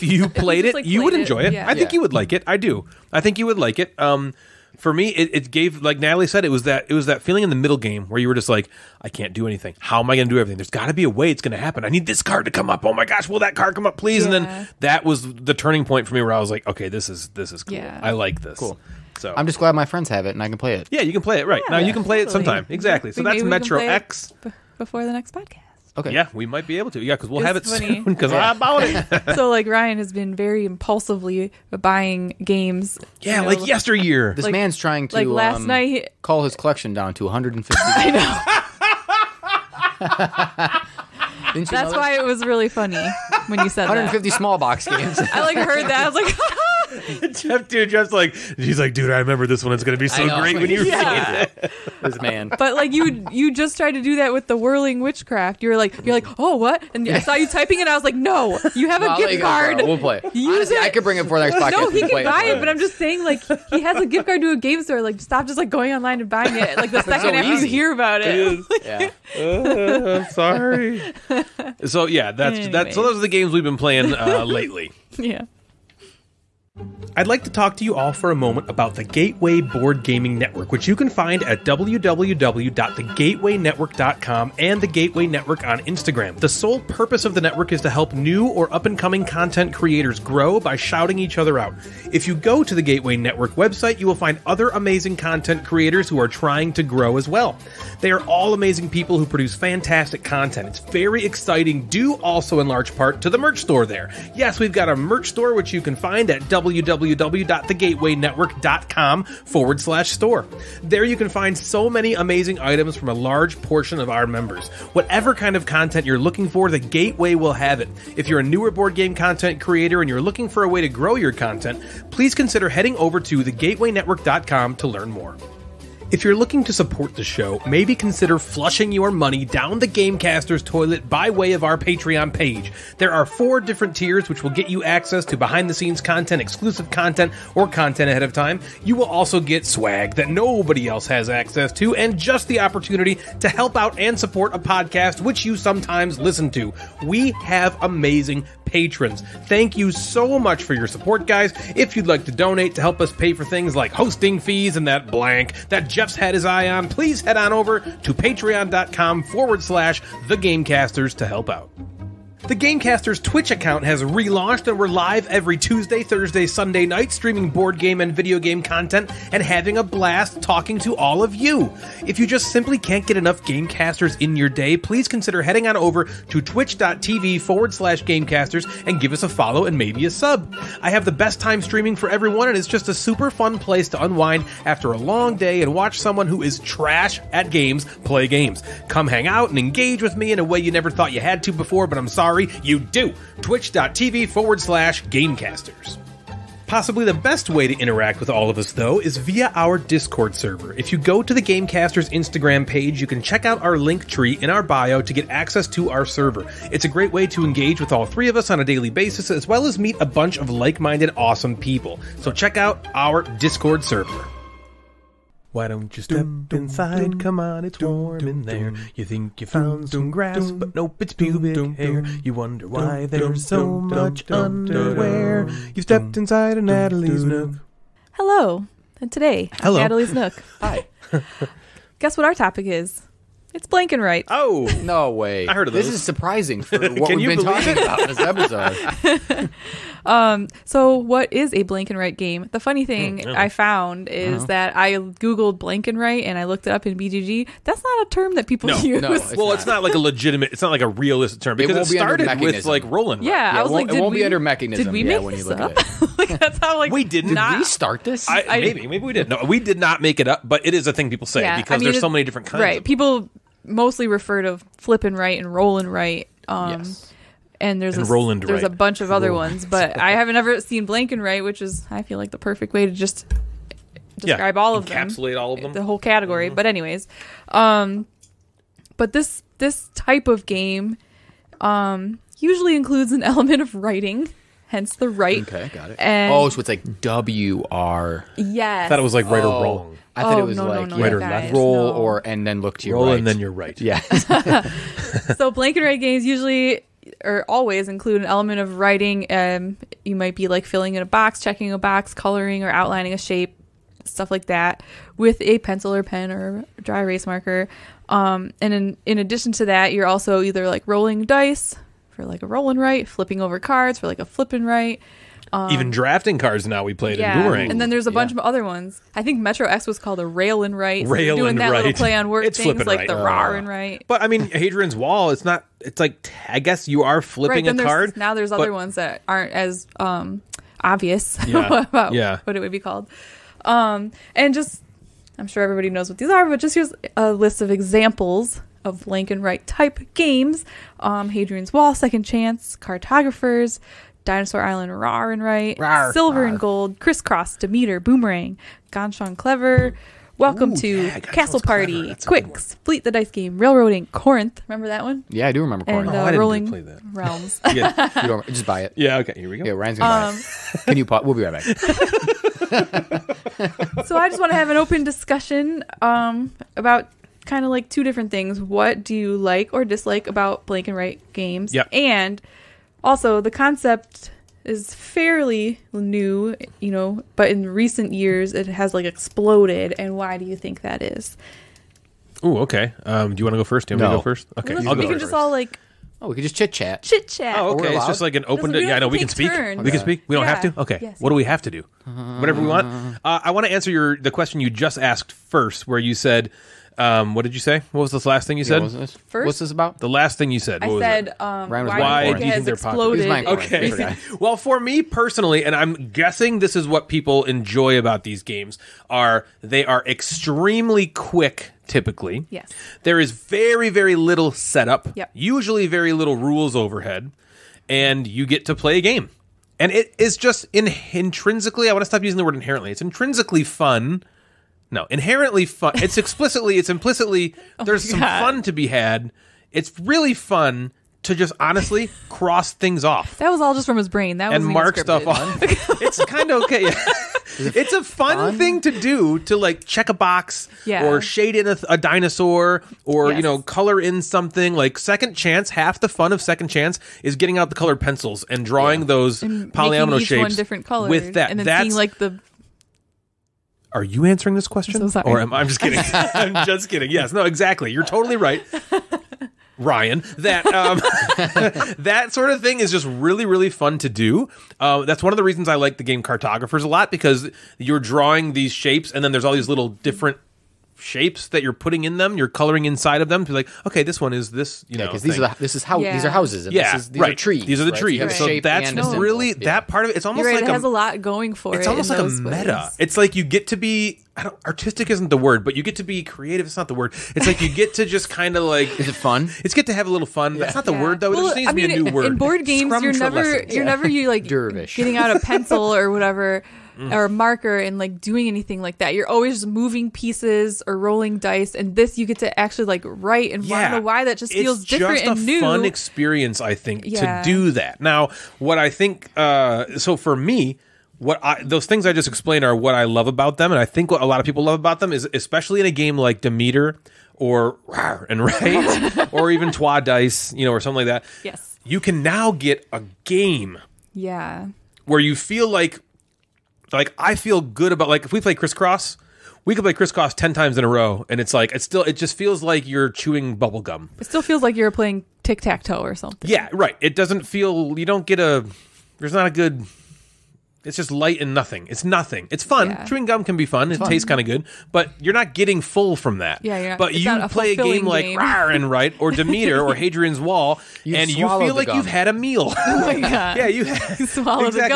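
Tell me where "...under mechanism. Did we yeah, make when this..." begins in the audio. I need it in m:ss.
4:14.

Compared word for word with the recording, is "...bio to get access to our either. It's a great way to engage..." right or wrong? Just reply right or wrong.
wrong.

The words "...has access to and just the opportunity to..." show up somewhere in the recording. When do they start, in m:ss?
2:21.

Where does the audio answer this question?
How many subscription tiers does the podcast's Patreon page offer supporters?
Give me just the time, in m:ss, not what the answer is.
2:13.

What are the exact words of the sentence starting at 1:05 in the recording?
Like stop just like going online and buying it.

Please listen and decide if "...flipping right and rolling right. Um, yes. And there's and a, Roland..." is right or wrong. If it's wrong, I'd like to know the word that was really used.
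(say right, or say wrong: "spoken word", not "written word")
right.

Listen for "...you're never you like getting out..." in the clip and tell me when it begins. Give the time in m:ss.
8:13.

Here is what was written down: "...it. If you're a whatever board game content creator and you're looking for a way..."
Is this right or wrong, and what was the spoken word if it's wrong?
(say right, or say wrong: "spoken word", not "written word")
wrong: "newer", not "whatever".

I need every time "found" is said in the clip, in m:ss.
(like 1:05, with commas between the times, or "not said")
3:39, 4:03.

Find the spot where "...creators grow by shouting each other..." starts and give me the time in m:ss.
1:29.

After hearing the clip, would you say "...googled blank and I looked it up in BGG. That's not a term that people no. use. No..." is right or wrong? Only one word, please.
right.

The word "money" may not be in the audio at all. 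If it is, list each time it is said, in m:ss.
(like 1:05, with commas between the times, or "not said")
2:09.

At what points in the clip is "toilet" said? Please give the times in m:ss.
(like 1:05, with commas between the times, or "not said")
2:10.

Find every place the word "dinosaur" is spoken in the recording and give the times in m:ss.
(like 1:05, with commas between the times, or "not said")
5:44, 7:21.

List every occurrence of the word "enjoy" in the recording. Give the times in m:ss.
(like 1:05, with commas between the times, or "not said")
0:01, 6:47.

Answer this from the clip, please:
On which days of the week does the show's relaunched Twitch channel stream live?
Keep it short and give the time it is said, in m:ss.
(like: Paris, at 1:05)
Tuesday, Thursday, Sunday, at 2:45.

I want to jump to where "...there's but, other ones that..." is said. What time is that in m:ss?
5:28.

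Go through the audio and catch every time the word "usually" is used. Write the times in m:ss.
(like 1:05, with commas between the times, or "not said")
4:42, 4:56, 6:55.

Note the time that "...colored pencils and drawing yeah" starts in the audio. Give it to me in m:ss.
7:27.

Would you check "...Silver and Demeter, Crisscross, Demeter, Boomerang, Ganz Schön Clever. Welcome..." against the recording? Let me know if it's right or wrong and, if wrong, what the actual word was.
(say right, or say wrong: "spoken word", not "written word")
wrong: "Gold", not "Demeter".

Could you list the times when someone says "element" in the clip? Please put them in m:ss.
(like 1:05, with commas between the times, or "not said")
4:43, 4:58.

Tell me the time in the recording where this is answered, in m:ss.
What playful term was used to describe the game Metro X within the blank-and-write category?
5:20.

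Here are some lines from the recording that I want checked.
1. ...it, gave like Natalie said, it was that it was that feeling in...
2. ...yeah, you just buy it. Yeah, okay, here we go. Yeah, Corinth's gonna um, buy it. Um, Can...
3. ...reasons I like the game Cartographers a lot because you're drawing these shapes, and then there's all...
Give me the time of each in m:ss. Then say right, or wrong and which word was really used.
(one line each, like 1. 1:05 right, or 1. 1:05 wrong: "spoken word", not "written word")
1. 0:05 right
2. 5:57 wrong: "Ryan", not "Corinth"
3. 7:45 right.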